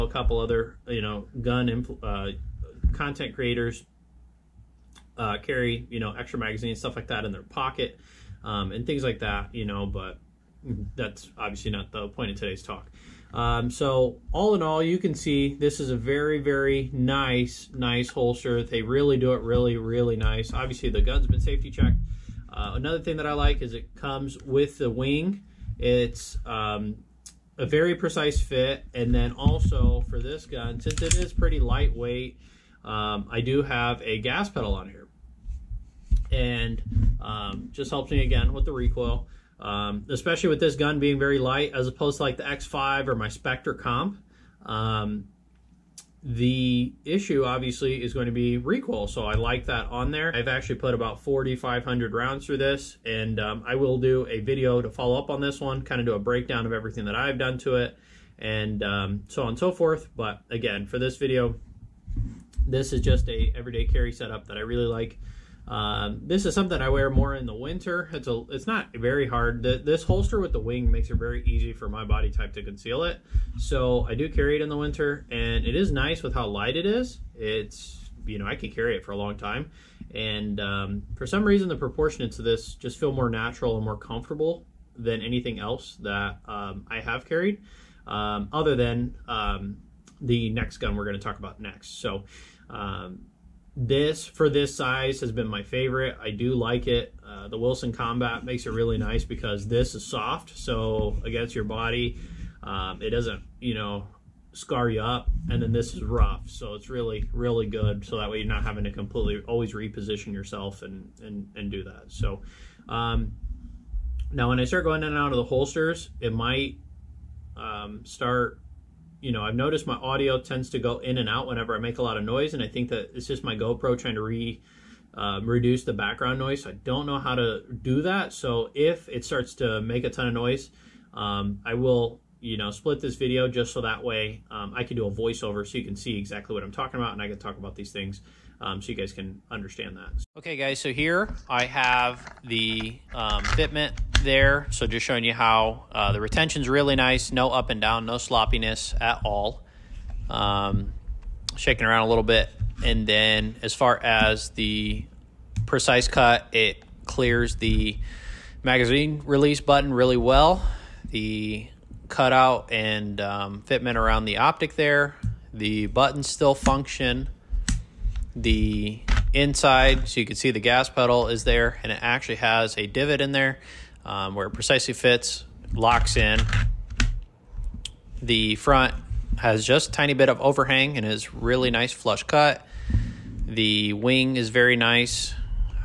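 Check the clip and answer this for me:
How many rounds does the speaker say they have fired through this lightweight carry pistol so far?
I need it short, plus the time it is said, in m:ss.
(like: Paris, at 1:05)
4,500, at 0:51.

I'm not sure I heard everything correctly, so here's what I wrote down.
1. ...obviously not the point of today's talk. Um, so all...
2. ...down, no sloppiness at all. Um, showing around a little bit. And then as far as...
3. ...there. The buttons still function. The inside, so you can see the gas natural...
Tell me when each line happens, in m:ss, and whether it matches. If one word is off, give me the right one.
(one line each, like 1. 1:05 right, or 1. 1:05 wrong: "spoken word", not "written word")
1. 0:11 right
2. 2:27 wrong: "shaking", not "showing"
3. 2:44 wrong: "pedal", not "natural".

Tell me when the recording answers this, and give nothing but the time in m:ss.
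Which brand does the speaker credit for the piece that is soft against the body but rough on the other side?
1:37.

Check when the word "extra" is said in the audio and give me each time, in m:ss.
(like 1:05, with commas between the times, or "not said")
0:06.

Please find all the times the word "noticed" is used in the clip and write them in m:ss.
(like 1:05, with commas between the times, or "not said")
1:59.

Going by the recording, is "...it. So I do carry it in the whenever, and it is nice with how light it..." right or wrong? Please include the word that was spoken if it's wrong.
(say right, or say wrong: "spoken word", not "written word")
wrong: "winter", not "whenever".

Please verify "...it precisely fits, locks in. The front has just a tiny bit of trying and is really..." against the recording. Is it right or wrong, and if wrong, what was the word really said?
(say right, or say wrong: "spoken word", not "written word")
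wrong: "overhang", not "trying".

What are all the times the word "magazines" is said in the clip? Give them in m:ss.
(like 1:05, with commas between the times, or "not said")
0:06, 2:38.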